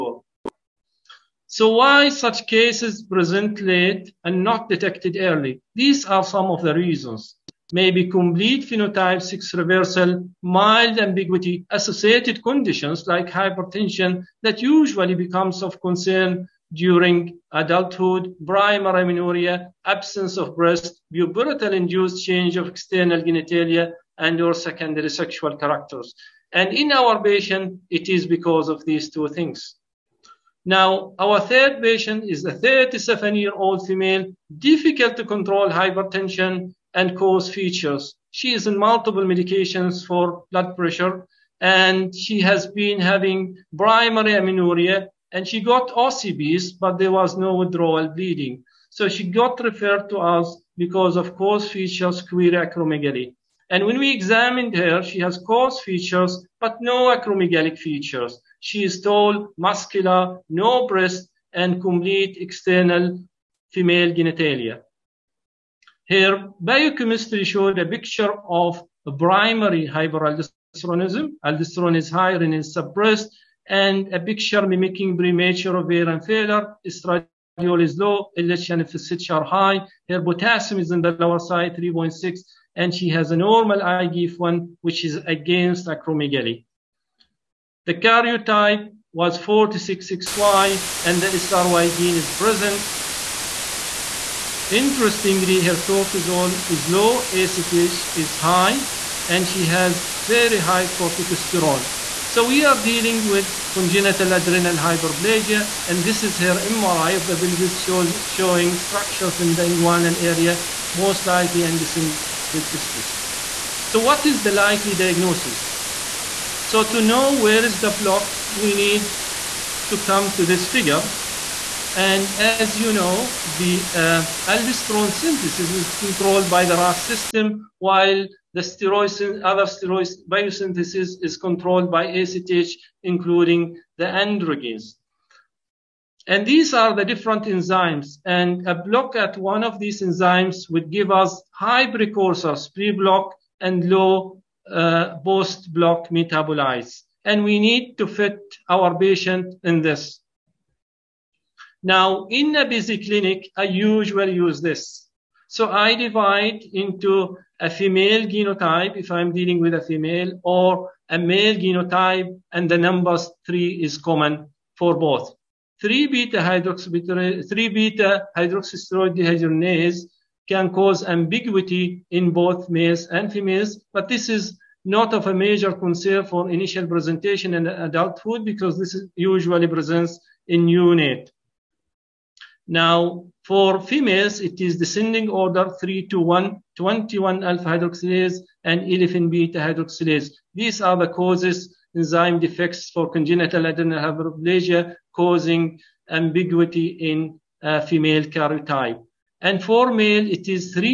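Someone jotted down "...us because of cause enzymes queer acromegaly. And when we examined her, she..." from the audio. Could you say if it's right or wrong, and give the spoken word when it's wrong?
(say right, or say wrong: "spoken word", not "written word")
wrong: "features", not "enzymes".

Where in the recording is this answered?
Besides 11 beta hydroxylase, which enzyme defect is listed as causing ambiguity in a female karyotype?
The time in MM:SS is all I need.
03:06.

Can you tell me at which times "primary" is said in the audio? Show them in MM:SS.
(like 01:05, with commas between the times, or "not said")
00:18, 00:43, 01:09.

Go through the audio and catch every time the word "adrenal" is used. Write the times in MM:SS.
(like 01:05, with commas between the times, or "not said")
01:44, 03:13.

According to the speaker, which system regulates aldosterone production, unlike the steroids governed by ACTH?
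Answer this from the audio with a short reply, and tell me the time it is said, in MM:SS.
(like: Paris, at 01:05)
RAS system, at 02:06.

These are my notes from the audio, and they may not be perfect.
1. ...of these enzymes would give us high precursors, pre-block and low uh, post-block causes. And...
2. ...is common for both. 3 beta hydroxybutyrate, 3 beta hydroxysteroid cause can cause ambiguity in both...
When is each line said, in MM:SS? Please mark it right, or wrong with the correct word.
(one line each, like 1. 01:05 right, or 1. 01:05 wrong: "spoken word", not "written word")
1. 02:19 wrong: "metabolites", not "causes"
2. 02:43 wrong: "dehydrogenase", not "cause".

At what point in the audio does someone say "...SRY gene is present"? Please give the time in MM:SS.
01:31.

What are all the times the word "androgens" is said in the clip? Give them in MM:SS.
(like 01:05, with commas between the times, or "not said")
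02:14.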